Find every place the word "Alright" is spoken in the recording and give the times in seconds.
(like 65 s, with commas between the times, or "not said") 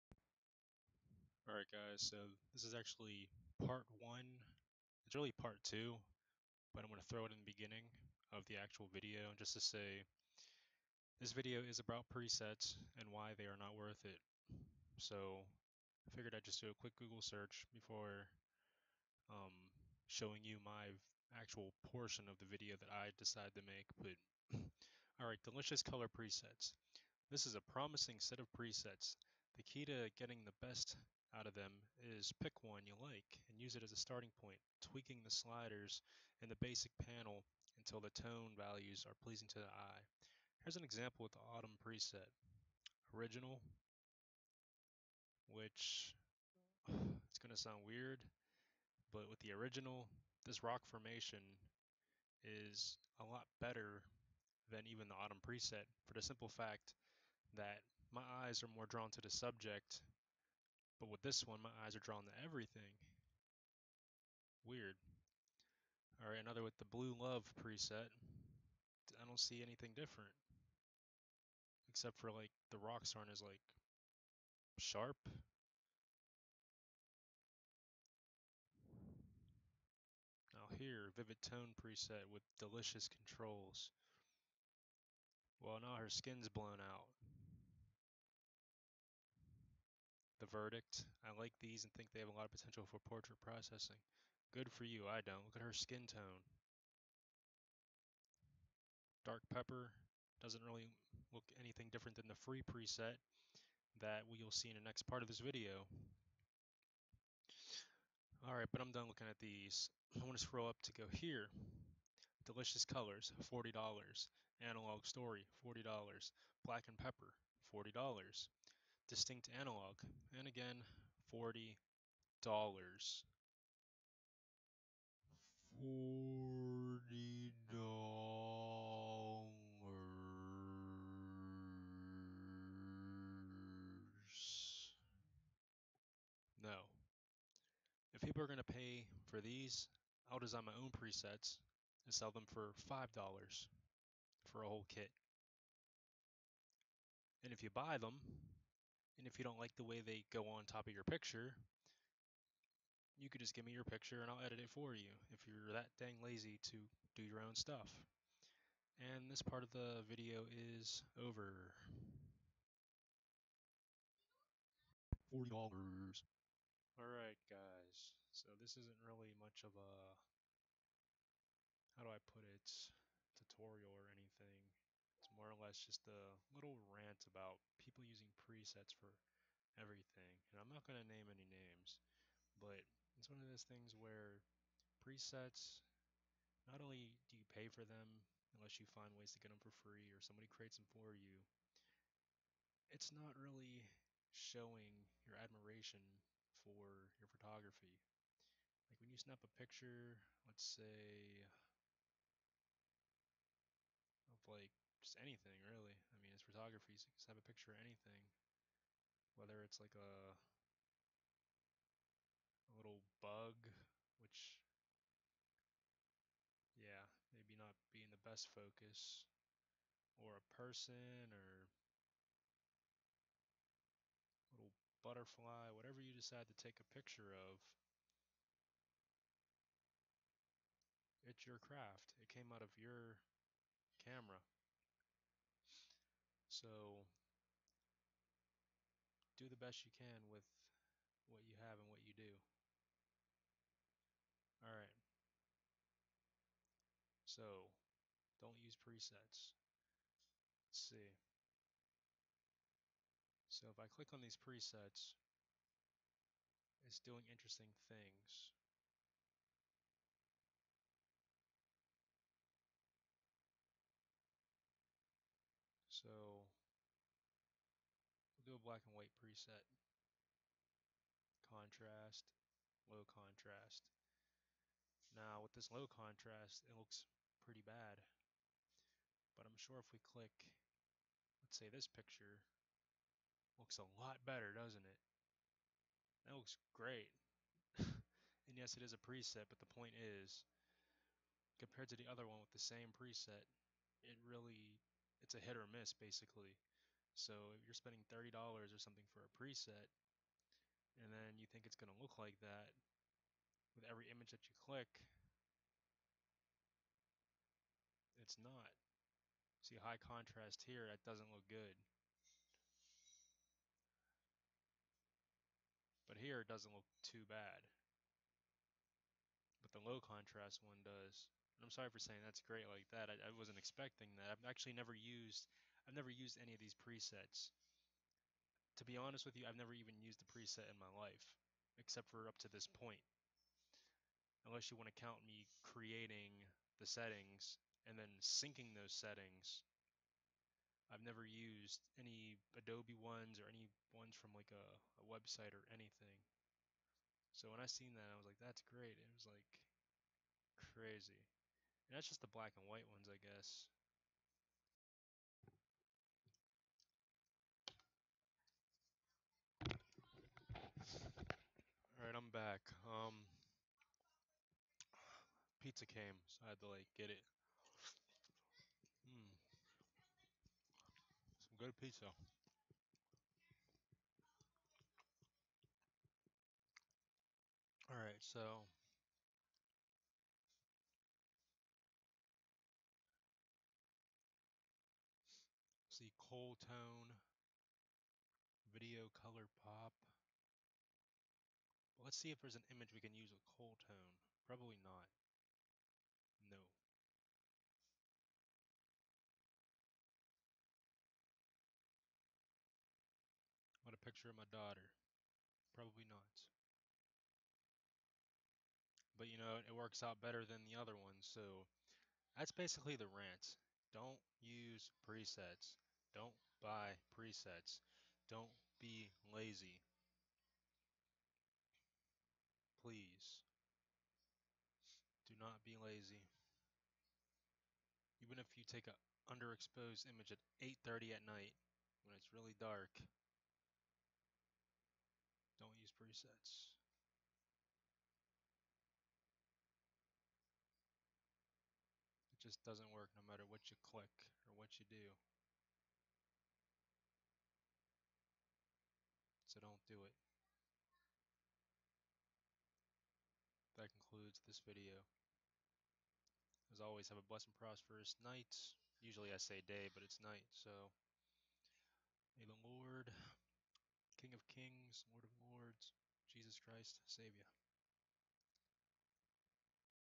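1 s, 25 s, 108 s, 165 s.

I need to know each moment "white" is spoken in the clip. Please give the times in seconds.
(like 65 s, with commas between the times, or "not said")
268 s, 352 s.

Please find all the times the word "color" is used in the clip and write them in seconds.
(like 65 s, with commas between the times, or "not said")
25 s, 112 s, 389 s.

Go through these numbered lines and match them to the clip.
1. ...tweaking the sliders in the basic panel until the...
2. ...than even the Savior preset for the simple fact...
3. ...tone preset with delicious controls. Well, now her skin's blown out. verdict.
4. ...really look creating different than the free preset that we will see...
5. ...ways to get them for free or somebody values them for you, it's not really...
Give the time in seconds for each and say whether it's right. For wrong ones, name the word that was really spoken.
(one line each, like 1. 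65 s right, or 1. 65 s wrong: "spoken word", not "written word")
1. 34 s right
2. 54 s wrong: "Autumn", not "Savior"
3. 81 s right
4. 100 s wrong: "anything", not "creating"
5. 189 s wrong: "creates", not "values".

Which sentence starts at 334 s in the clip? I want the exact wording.
Unless you want to count me creating the settings and then syncing those settings.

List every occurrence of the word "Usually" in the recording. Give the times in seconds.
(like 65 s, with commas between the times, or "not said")
459 s.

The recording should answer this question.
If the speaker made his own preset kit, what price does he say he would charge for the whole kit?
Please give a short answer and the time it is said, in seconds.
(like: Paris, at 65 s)
$5, at 142 s.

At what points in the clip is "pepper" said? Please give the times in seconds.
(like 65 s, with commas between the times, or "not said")
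99 s, 116 s.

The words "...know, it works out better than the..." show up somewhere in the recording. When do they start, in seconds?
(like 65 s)
409 s.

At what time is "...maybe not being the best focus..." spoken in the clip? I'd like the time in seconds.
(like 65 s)
217 s.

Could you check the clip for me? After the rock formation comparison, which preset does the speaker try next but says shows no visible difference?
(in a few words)
Blue love.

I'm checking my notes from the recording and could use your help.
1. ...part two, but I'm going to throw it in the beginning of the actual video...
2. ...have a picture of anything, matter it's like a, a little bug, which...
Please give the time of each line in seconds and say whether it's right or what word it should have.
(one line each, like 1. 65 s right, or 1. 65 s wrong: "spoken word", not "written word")
1. 5 s right
2. 207 s wrong: "whether", not "matter".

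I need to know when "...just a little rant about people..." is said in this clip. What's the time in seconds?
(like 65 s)
175 s.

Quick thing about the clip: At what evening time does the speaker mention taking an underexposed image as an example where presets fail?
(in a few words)
8:30.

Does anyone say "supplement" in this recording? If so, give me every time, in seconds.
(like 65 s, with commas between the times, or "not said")
not said.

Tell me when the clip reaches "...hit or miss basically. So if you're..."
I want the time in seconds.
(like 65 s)
295 s.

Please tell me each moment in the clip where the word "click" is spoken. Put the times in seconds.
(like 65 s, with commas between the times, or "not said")
253 s, 280 s, 304 s, 443 s.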